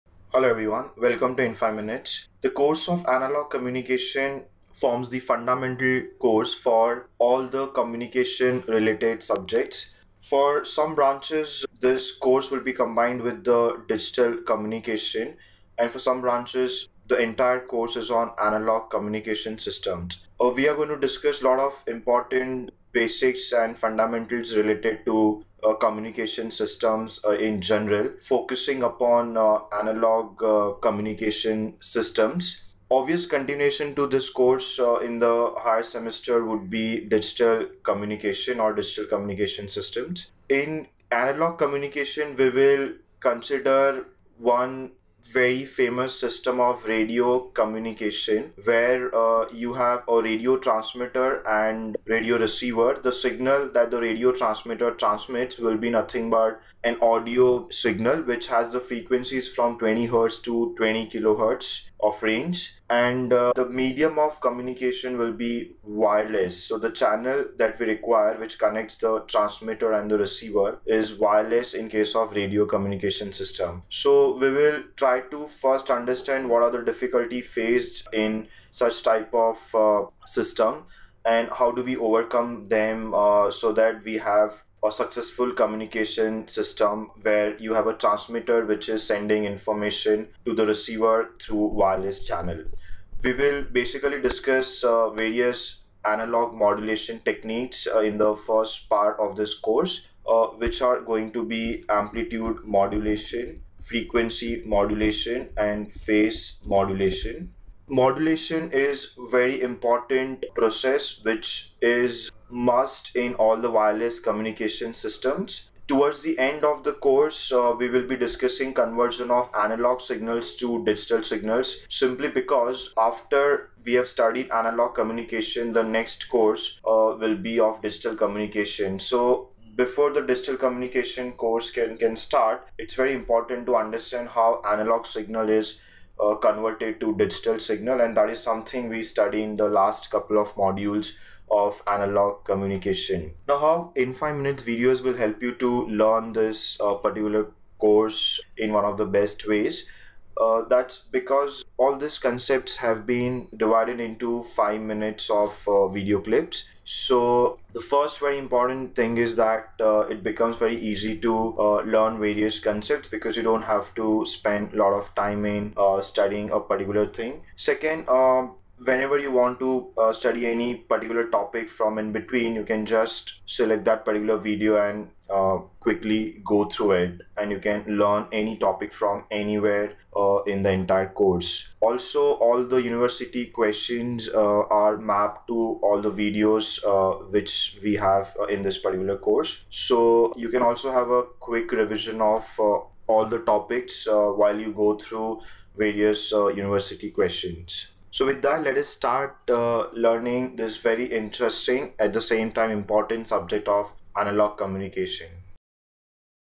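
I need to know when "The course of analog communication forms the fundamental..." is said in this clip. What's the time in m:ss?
0:02.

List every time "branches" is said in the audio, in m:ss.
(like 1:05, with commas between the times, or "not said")
0:10, 0:16.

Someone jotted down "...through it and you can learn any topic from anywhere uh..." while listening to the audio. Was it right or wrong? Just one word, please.
right.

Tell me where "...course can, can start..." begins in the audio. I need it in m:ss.
2:11.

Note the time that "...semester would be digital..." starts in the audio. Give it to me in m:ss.
0:35.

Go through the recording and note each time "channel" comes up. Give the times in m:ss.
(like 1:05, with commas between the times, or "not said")
1:06, 1:32.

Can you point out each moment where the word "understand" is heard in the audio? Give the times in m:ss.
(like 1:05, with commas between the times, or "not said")
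1:15, 2:13.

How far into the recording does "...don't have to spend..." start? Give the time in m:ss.
2:43.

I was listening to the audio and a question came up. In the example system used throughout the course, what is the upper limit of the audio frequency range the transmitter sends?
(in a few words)
20 kilohertz.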